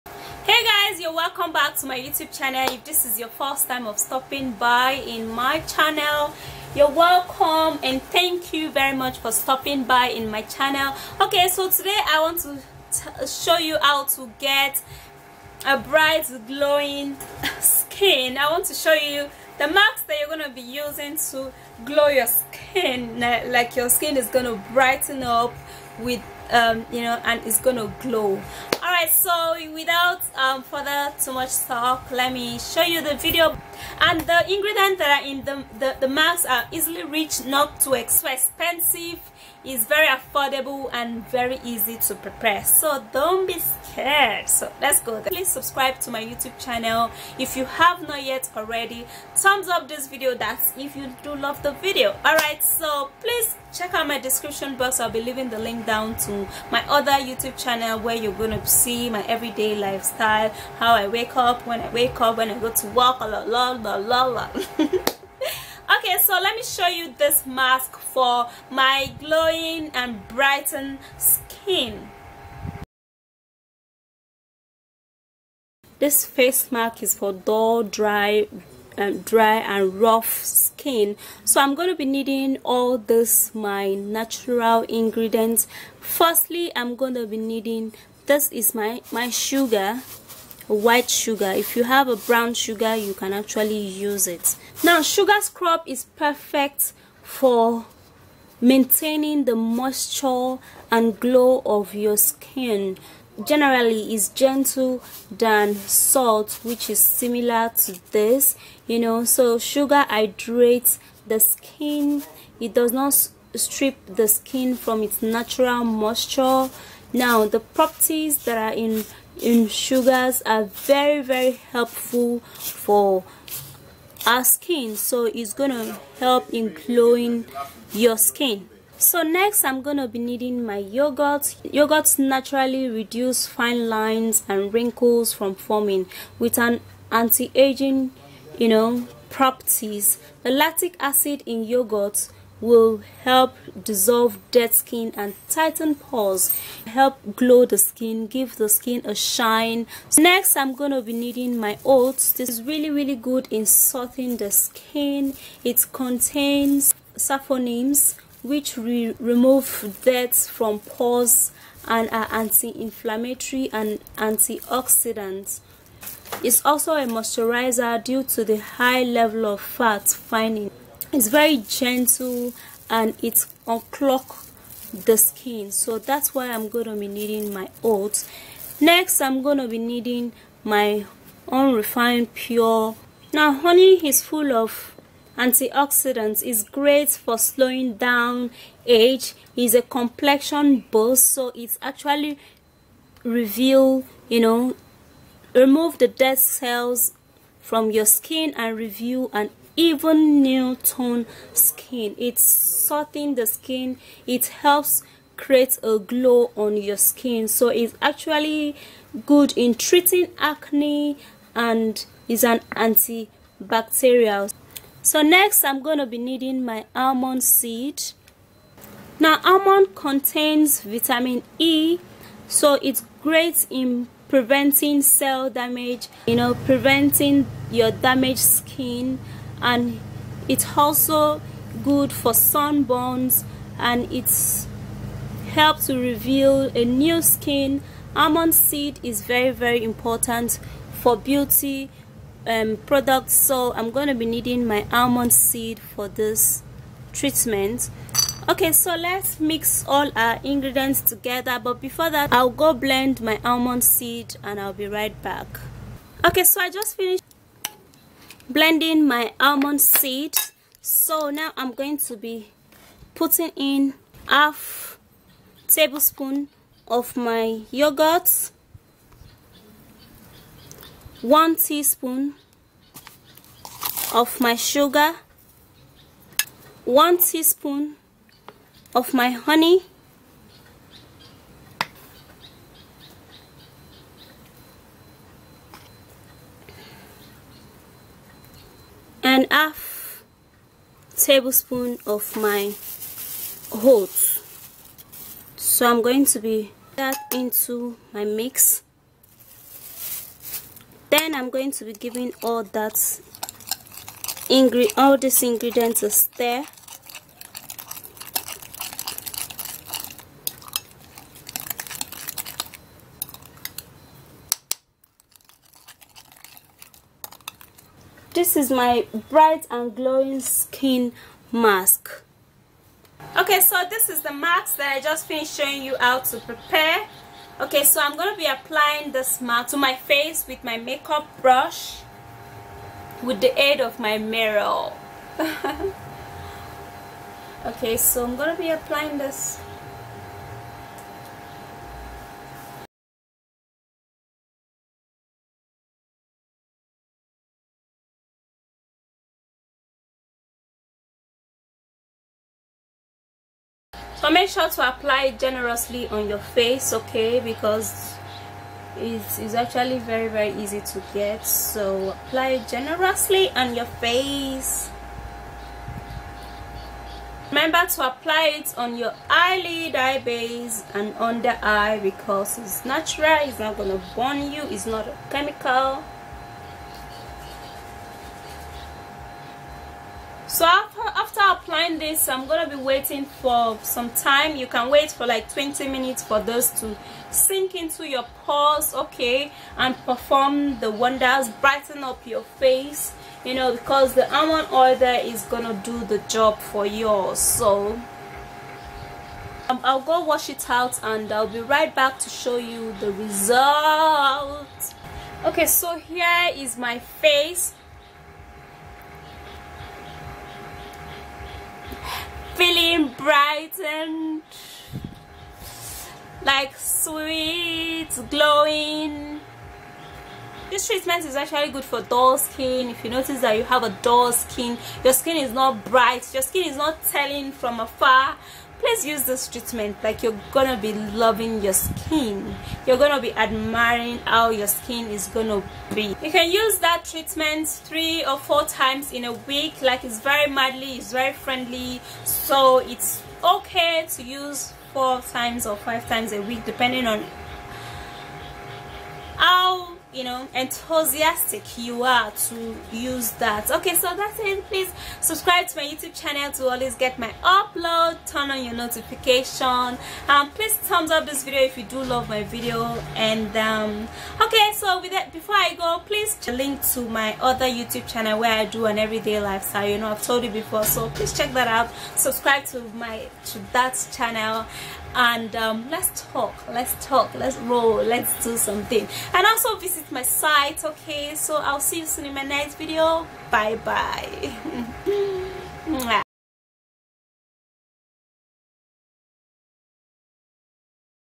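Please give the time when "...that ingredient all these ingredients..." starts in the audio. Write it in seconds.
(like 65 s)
302 s.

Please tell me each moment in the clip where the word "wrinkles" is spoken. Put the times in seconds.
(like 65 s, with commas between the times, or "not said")
134 s.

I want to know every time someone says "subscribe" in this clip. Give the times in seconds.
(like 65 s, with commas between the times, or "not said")
45 s, 455 s, 472 s.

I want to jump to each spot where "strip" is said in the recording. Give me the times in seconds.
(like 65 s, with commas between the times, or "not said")
113 s.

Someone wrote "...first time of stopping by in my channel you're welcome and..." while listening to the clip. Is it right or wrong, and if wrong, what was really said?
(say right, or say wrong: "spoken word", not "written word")
right.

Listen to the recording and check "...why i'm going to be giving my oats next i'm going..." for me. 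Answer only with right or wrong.
wrong.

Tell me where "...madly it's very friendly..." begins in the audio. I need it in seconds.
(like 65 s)
440 s.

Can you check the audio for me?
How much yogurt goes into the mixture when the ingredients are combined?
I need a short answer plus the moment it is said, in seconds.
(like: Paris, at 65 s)
half tablespoon, at 264 s.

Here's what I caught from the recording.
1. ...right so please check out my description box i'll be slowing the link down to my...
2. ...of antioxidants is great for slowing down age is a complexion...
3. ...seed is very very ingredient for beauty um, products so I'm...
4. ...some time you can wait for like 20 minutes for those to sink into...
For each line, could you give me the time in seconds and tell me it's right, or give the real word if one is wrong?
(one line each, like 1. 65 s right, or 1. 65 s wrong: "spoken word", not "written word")
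1. 52 s wrong: "leaving", not "slowing"
2. 184 s right
3. 238 s wrong: "important", not "ingredient"
4. 383 s right.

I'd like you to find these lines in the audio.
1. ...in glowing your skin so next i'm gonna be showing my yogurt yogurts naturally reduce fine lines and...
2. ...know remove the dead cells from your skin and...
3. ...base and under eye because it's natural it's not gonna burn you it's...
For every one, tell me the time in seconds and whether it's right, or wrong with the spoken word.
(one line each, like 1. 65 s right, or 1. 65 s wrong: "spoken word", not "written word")
1. 126 s wrong: "needing", not "showing"
2. 194 s right
3. 370 s right.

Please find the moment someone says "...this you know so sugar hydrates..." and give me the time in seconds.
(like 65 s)
108 s.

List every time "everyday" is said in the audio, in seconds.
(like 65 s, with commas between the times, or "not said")
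59 s, 468 s.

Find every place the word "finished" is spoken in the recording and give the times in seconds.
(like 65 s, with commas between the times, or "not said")
256 s, 325 s.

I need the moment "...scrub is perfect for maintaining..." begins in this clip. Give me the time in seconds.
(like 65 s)
95 s.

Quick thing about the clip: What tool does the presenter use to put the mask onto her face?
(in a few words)
makeup brush.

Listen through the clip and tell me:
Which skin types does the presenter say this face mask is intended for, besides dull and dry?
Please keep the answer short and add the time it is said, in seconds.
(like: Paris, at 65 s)
rough, at 80 s.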